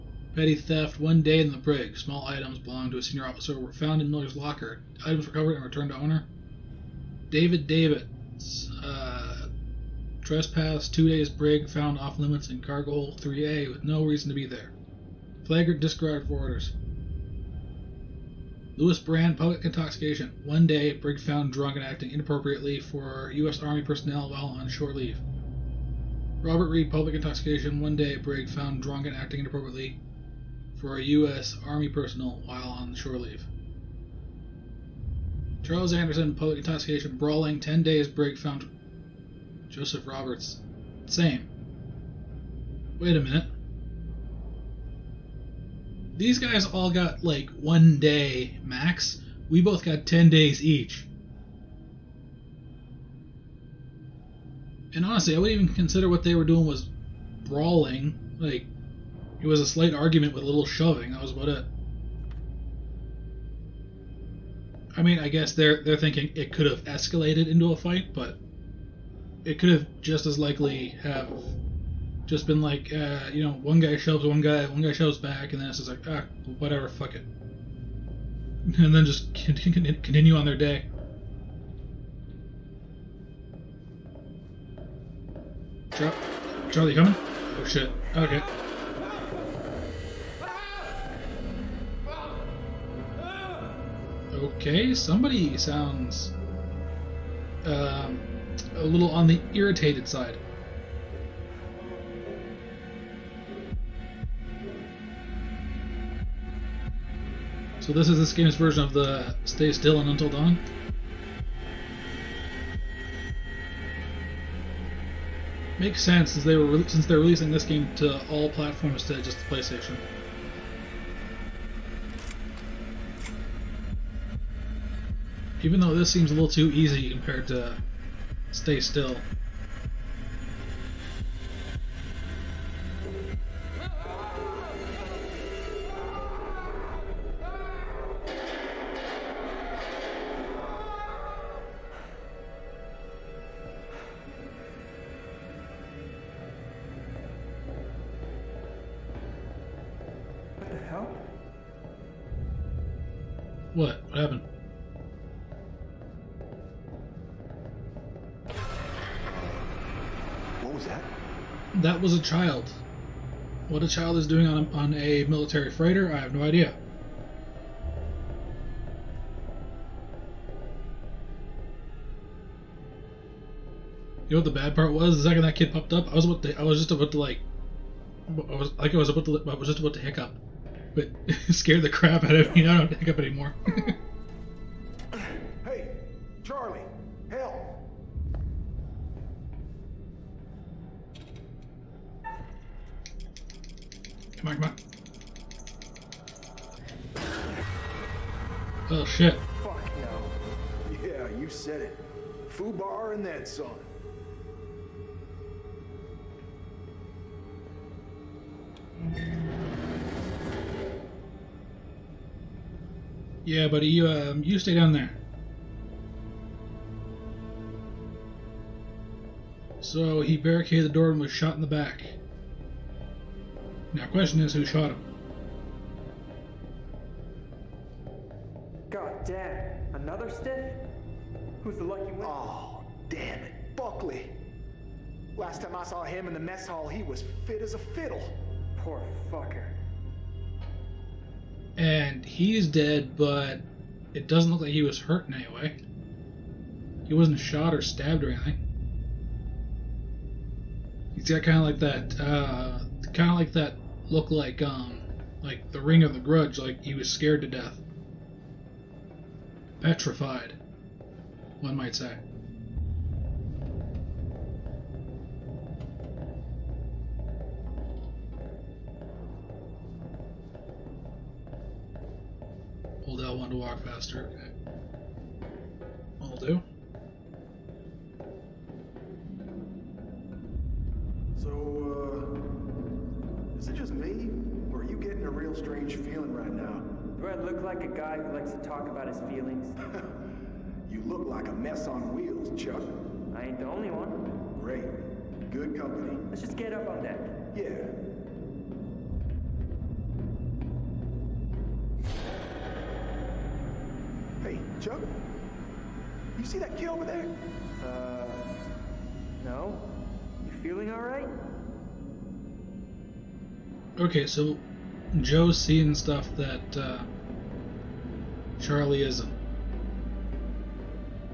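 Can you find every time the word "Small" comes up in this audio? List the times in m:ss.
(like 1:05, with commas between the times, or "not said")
0:01.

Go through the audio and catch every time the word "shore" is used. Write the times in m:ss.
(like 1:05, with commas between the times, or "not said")
0:24, 0:32.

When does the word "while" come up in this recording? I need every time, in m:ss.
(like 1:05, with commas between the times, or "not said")
0:24, 0:32.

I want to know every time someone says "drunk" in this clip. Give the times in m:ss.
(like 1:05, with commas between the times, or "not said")
0:21, 0:28.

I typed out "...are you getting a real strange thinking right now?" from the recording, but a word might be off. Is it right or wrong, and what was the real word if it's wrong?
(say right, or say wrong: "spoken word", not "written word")
wrong: "feeling", not "thinking".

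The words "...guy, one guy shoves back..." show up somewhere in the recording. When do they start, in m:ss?
1:14.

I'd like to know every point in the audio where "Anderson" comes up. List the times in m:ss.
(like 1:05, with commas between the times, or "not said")
0:35.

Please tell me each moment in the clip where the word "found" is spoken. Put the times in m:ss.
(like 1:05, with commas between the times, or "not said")
0:03, 0:11, 0:21, 0:28, 0:38.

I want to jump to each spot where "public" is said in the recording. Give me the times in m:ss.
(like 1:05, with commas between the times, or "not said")
0:19, 0:26, 0:36.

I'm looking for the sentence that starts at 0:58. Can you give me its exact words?
Like, it was a slight argument with a little shoving.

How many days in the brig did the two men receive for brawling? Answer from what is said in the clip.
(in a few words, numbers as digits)
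10.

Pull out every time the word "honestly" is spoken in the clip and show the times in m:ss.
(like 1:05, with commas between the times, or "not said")
0:55.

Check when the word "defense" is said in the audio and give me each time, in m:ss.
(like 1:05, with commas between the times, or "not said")
not said.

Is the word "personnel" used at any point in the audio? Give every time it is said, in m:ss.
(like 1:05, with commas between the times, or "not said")
0:23, 0:31.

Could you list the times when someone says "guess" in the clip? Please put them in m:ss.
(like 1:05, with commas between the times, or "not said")
1:05.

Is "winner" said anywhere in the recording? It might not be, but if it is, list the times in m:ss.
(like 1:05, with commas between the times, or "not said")
3:52.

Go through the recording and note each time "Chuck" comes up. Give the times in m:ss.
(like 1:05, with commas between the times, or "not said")
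4:52, 5:04.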